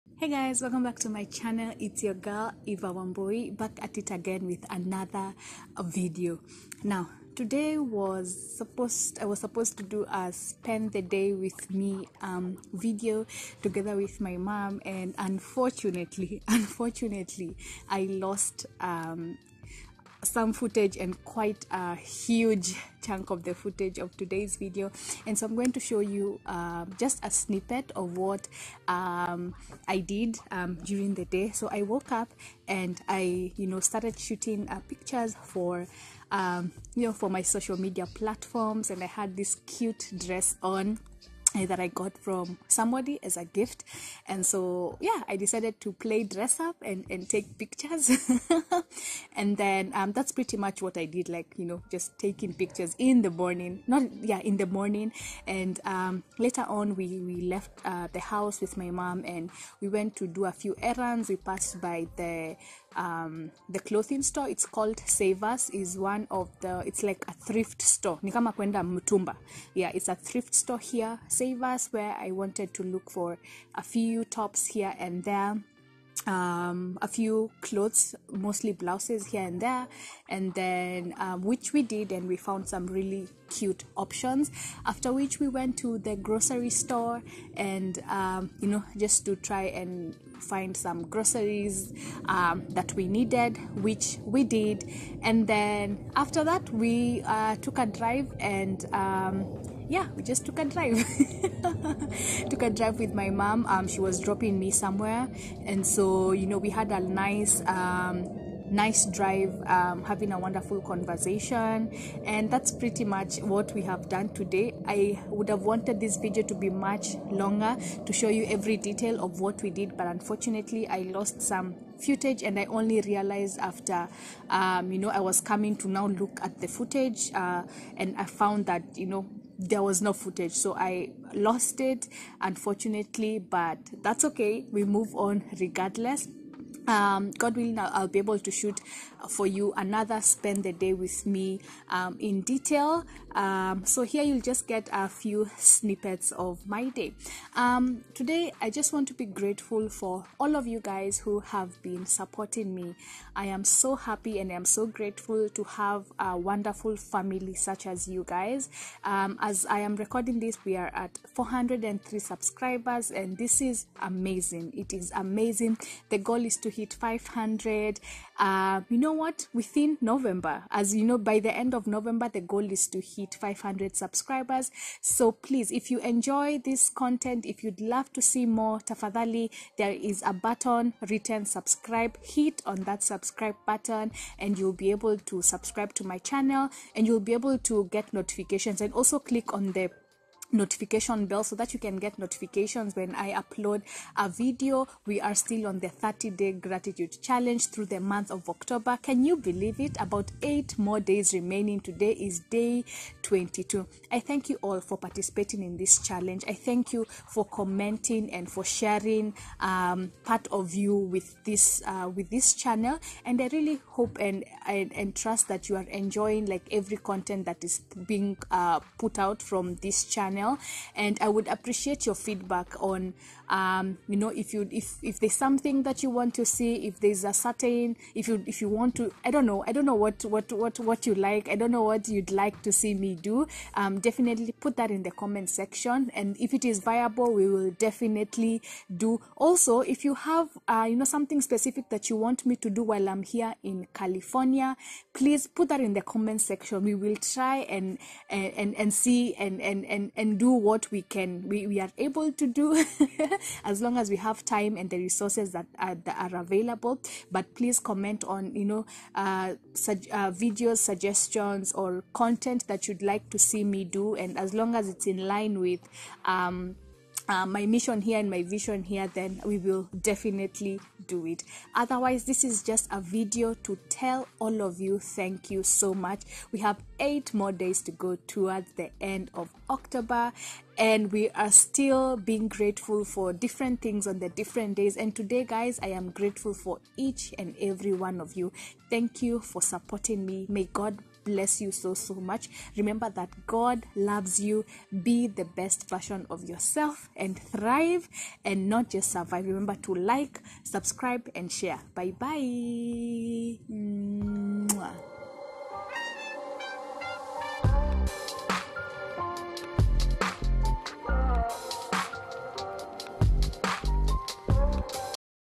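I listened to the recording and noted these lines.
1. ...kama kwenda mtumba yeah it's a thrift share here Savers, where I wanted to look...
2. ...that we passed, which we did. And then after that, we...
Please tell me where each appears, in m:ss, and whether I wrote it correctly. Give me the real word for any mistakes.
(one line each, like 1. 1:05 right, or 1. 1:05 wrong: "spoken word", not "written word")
1. 1:08 wrong: "store", not "share"
2. 1:32 wrong: "needed", not "passed".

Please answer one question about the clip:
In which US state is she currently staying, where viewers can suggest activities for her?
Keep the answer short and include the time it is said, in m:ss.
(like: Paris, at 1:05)
California, at 4:03.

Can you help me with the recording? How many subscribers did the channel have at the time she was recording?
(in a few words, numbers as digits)
403.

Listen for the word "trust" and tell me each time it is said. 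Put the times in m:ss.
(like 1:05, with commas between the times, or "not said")
3:35.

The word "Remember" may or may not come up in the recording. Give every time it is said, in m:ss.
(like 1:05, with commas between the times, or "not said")
4:52, 4:59.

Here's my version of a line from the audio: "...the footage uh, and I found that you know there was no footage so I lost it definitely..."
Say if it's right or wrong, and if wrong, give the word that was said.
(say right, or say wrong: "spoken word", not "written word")
wrong: "unfortunately", not "definitely".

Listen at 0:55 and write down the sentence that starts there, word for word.
And um, later on, we, we left uh, the house with my mom and we went to do a few errands.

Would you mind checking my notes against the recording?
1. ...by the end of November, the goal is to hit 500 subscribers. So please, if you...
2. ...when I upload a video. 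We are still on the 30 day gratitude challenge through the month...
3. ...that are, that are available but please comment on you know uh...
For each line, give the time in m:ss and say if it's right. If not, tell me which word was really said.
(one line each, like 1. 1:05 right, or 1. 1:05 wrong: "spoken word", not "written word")
1. 2:51 right
2. 3:12 right
3. 4:15 right.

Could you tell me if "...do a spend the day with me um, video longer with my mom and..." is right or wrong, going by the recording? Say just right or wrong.
wrong.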